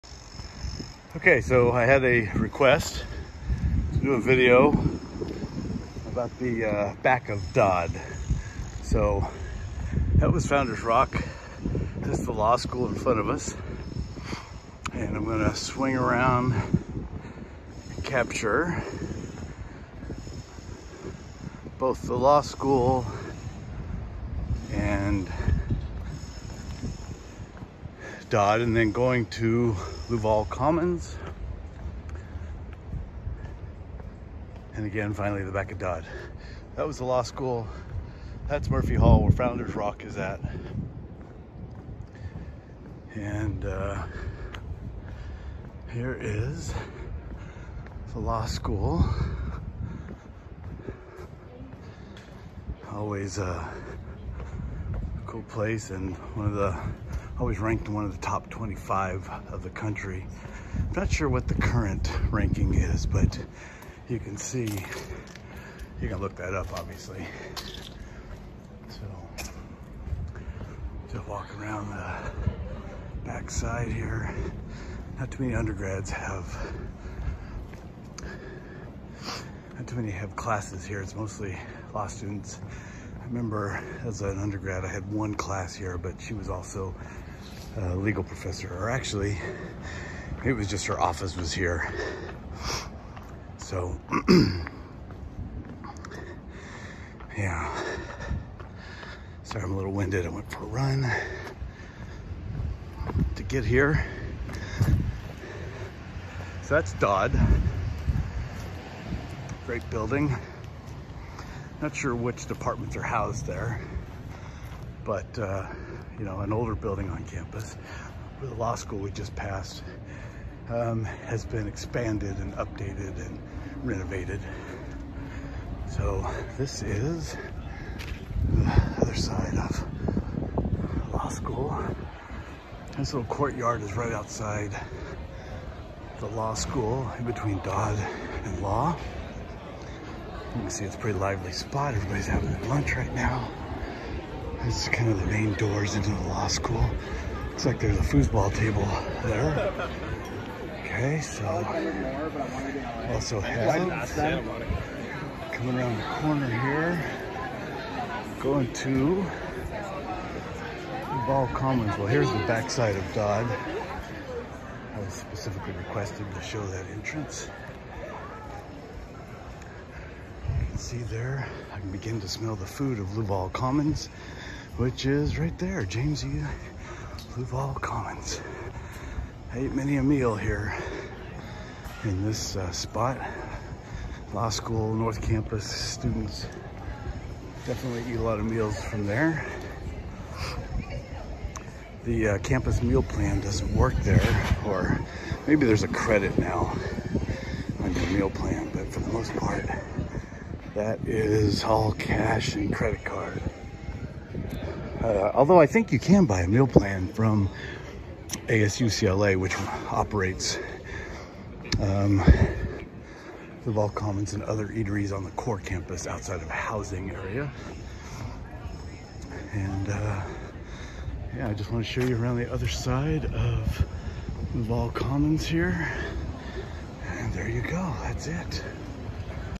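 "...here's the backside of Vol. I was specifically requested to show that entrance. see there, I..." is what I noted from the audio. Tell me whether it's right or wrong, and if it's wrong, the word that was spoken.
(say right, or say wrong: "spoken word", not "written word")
wrong: "Dodd", not "Vol".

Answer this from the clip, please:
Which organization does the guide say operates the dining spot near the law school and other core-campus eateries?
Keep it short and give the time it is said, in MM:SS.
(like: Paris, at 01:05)
ASUCLA, at 03:28.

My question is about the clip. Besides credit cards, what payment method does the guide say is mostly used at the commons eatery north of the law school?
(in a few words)
cash.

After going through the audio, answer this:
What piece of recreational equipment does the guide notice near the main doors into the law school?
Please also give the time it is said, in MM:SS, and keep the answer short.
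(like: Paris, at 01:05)
foosball table, at 02:28.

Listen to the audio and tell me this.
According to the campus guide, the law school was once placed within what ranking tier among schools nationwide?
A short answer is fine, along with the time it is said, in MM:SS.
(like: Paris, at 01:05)
top 25, at 00:58.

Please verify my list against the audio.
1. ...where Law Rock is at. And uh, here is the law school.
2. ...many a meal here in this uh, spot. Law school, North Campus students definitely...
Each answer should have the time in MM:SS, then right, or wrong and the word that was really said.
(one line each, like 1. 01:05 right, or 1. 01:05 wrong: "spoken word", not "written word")
1. 00:39 wrong: "Founders", not "Law"
2. 02:59 right.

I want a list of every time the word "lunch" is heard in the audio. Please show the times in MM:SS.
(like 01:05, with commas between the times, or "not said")
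02:22.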